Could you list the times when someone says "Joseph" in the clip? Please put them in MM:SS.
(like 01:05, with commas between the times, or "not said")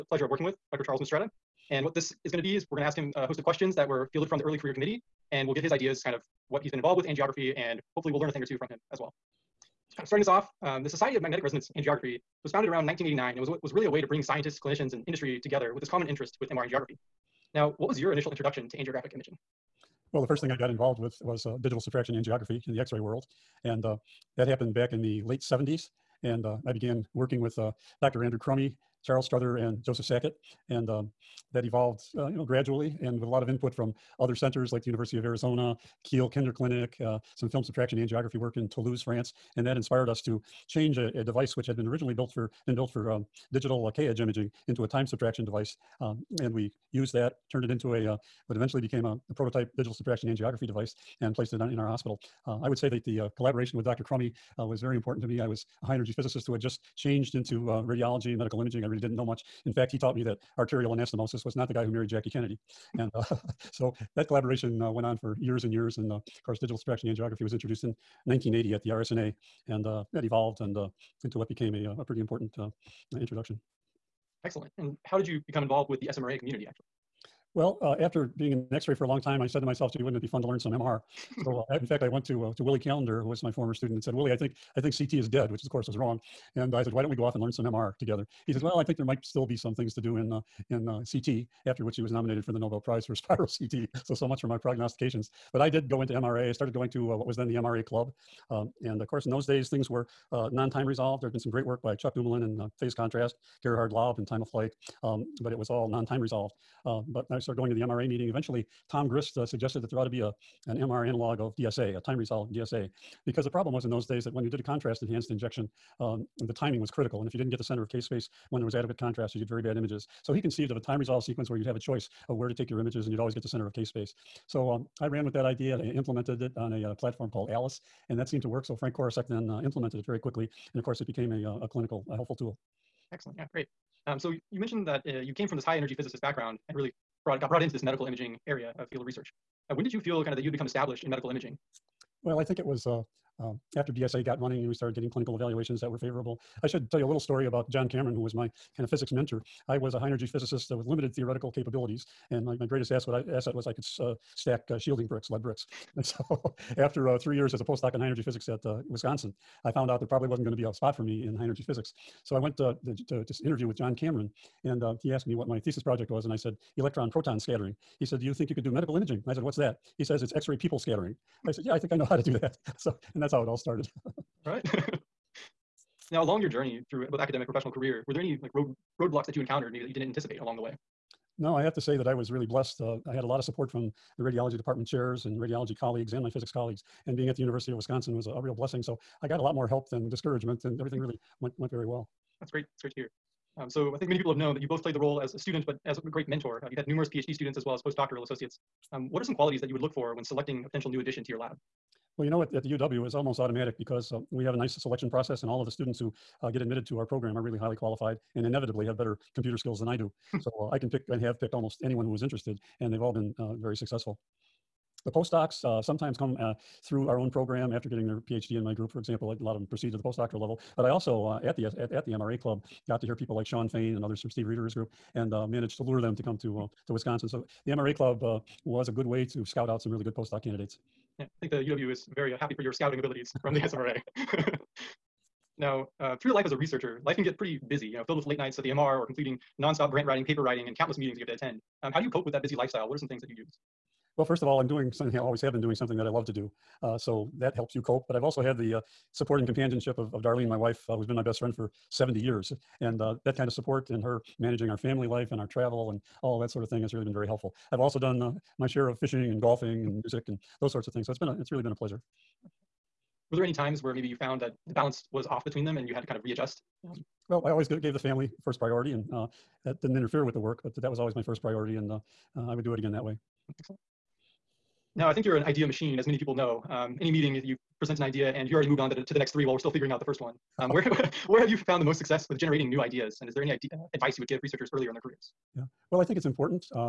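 00:29.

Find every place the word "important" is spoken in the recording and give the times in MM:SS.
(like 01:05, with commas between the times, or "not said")
00:54, 01:12, 04:46.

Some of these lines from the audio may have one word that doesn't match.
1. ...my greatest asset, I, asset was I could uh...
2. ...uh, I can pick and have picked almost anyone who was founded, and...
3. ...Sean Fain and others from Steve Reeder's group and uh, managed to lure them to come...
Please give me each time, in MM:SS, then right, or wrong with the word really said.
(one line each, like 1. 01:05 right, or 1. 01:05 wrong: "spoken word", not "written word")
1. 02:32 right
2. 03:30 wrong: "interested", not "founded"
3. 03:43 right.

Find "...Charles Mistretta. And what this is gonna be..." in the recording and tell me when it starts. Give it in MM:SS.
00:00.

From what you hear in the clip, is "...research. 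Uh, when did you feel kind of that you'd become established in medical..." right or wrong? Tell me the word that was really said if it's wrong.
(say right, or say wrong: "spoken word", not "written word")
right.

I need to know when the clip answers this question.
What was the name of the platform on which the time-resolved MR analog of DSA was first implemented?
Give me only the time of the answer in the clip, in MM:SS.
02:07.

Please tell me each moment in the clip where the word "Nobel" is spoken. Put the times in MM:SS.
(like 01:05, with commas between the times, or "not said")
01:32.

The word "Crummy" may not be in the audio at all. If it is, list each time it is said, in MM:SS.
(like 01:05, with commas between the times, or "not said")
00:28, 00:54.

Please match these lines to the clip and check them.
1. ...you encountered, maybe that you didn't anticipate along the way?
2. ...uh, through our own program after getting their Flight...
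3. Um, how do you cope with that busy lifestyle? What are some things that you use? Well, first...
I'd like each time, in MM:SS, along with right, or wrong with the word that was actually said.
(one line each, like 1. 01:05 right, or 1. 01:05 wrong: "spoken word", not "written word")
1. 02:59 right
2. 03:36 wrong: "PhD", not "Flight"
3. 04:01 right.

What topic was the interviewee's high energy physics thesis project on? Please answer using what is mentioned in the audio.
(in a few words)
Electron proton scattering.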